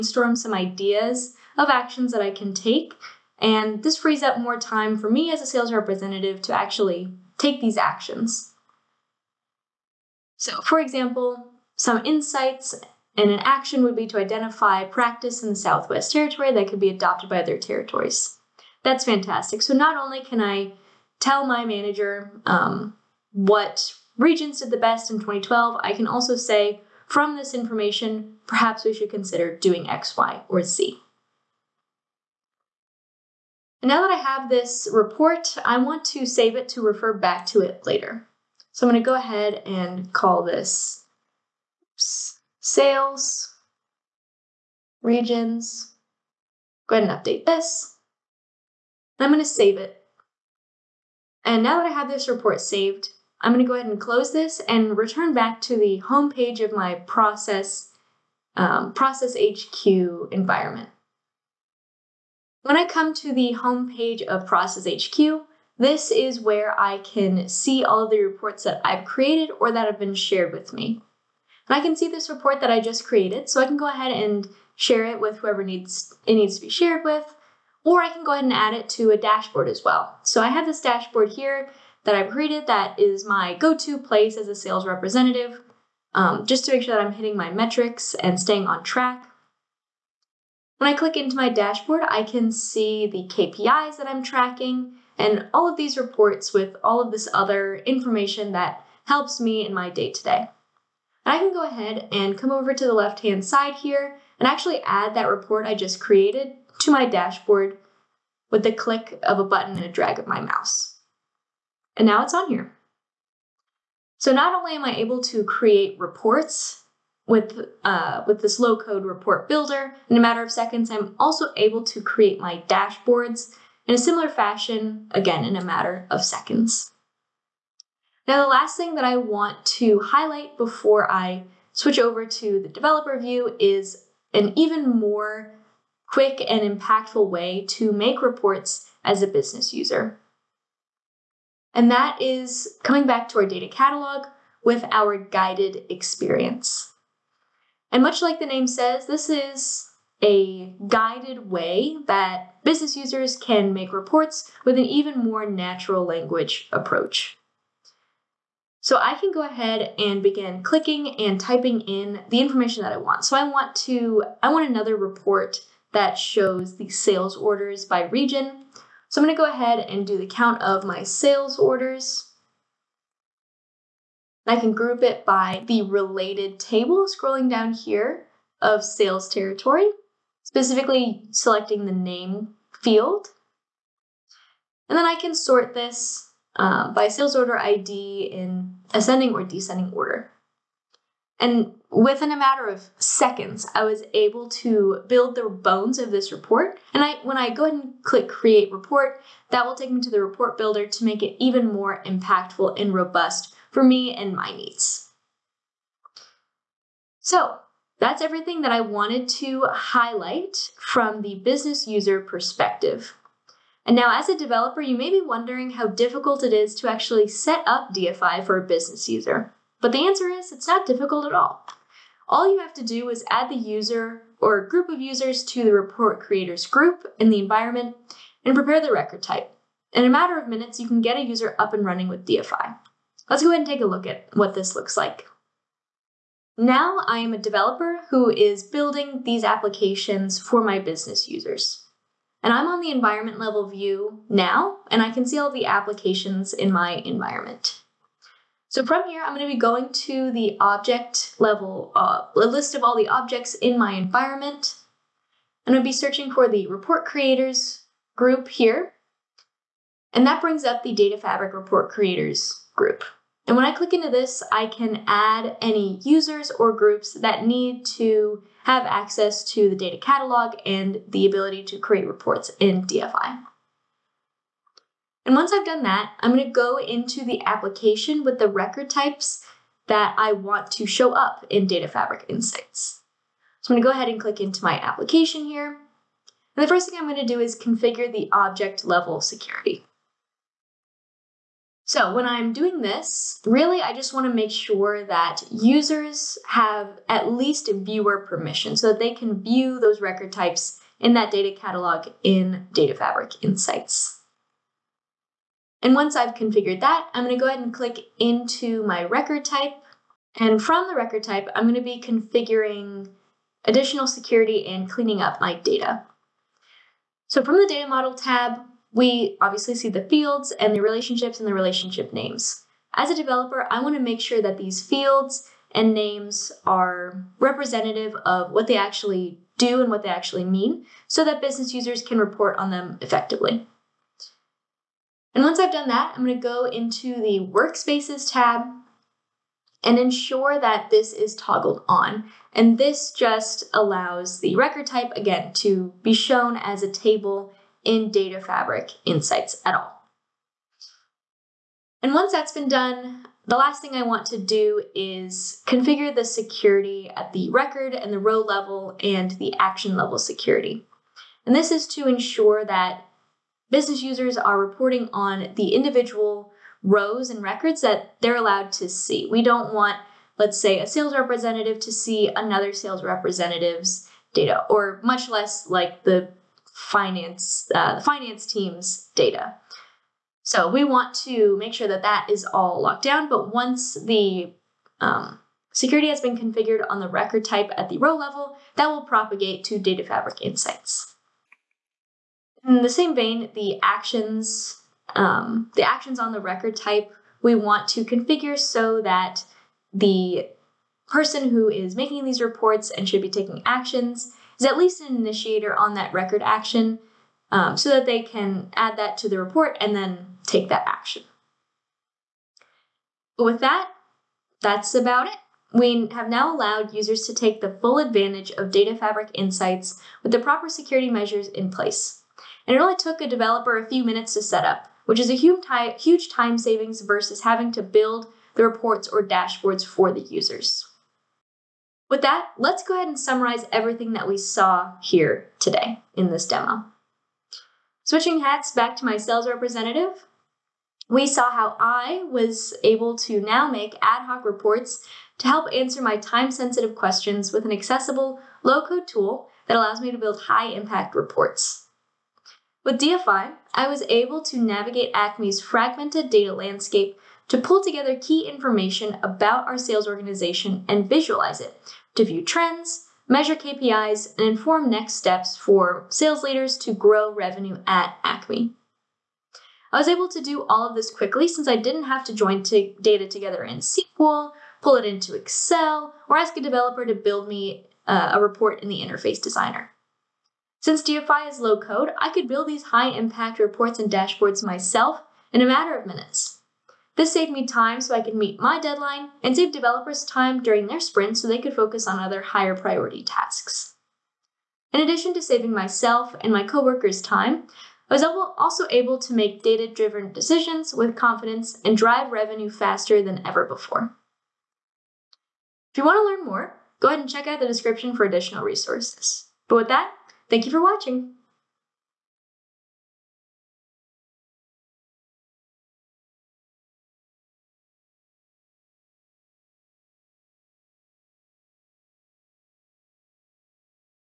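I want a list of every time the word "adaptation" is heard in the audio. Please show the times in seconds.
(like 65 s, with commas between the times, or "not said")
not said.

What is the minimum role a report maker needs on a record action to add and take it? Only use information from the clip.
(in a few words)
initiator.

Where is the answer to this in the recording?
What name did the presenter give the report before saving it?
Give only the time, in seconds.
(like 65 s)
42 s.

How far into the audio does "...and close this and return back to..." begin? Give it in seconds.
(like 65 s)
53 s.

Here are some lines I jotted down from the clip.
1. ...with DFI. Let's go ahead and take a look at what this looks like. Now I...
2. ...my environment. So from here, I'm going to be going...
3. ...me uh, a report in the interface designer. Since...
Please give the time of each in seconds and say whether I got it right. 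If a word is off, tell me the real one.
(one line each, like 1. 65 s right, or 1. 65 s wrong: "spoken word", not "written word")
1. 232 s right
2. 246 s right
3. 477 s right.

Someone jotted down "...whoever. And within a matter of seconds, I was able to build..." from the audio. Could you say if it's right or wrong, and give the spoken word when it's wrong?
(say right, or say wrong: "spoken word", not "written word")
wrong: "order", not "whoever".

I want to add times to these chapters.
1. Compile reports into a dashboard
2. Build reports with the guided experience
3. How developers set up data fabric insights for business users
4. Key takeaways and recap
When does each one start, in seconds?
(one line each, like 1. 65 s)
1. 63 s
2. 128 s
3. 209 s
4. 438 s.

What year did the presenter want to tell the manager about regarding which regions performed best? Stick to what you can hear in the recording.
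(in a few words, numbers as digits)
2012.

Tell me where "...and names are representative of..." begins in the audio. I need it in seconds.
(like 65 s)
325 s.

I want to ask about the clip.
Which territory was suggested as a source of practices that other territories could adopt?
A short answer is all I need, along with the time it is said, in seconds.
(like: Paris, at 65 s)
Southwest Territory, at 15 s.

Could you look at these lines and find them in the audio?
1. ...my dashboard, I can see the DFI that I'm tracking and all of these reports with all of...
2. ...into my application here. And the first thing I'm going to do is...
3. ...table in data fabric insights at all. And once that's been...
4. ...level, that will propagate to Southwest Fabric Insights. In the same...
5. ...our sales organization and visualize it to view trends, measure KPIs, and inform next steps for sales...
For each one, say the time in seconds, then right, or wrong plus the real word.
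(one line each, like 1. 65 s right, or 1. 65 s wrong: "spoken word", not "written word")
1. 91 s wrong: "KPIs", not "DFI"
2. 284 s right
3. 346 s right
4. 388 s wrong: "Data", not "Southwest"
5. 459 s right.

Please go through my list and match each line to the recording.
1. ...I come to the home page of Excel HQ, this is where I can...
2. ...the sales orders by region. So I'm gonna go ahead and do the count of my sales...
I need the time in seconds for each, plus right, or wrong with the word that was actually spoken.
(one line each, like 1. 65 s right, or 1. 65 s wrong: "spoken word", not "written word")
1. 62 s wrong: "Process", not "Excel"
2. 166 s right.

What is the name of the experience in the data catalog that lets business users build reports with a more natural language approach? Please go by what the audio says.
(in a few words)
guided experience.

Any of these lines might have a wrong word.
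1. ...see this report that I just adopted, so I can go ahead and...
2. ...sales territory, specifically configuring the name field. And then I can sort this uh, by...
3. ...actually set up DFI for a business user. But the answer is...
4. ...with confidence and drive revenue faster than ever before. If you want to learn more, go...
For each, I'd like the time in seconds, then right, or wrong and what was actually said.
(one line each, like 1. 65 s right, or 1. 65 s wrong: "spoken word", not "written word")
1. 71 s wrong: "created", not "adopted"
2. 178 s wrong: "selecting", not "configuring"
3. 216 s right
4. 500 s right.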